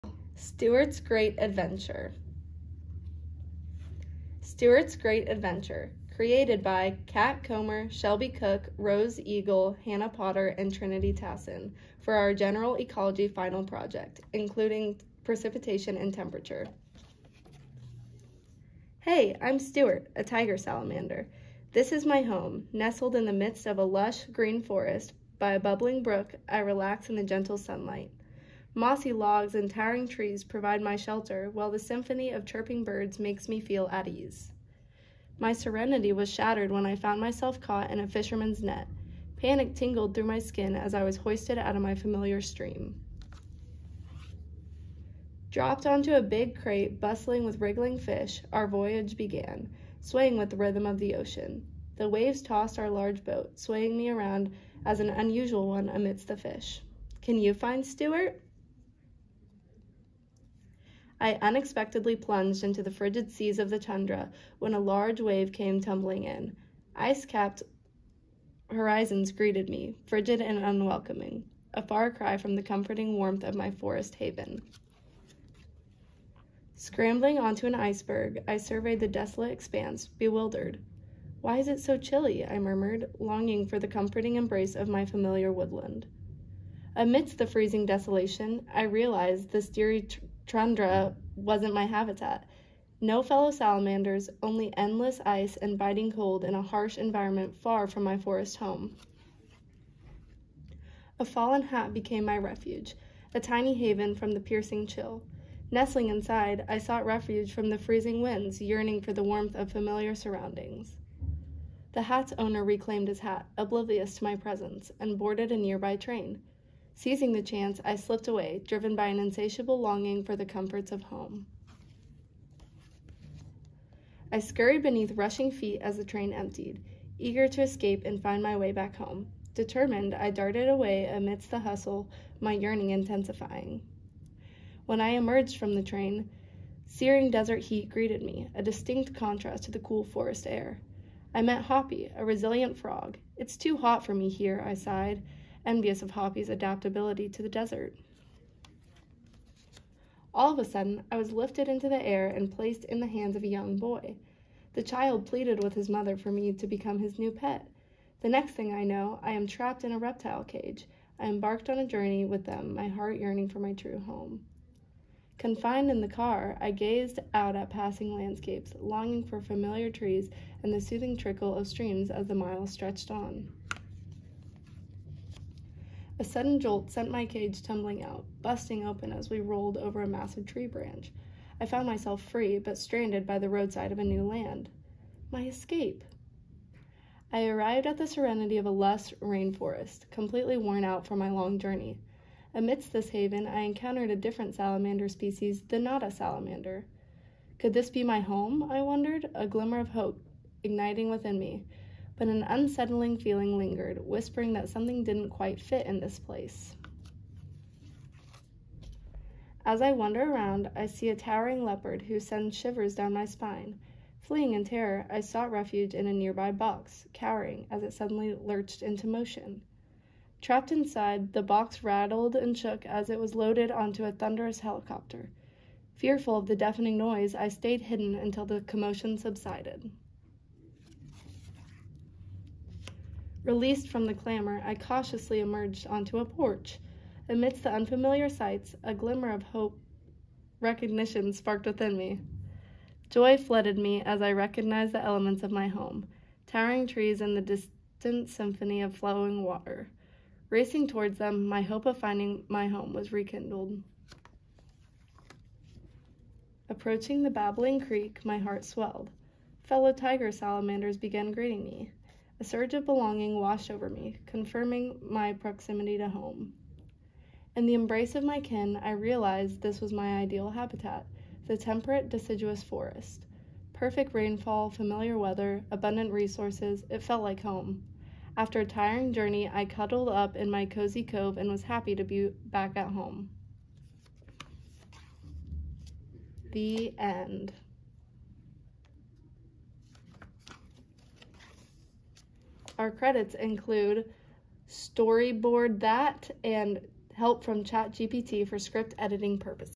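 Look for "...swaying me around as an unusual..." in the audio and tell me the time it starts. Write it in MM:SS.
00:53.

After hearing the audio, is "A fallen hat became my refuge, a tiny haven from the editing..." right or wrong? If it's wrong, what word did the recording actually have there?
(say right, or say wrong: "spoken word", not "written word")
wrong: "piercing", not "editing".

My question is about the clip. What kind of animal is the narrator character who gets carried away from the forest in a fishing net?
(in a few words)
Tiger salamander.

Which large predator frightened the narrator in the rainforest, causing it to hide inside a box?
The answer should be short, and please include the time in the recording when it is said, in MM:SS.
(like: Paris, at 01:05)
Leopard, at 03:31.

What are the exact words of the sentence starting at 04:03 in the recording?
Joy flooded me as I recognized the elements of my home towering trees and the distant symphony of flowing water.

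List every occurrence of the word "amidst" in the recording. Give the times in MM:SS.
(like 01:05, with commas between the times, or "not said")
00:55, 01:26, 02:11, 03:12, 03:57.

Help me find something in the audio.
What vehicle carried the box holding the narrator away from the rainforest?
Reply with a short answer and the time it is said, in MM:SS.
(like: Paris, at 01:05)
Helicopter, at 03:44.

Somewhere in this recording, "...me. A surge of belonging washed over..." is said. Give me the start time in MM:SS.
04:21.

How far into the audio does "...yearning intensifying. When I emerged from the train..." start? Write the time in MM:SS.
02:12.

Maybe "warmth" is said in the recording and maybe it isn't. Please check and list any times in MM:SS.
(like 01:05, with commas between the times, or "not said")
01:13, 01:49.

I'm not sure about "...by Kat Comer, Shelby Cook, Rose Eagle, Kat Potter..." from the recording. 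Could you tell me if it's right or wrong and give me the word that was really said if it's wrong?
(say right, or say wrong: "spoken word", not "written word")
wrong: "Hannah", not "Kat".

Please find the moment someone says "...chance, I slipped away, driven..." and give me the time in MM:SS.
01:57.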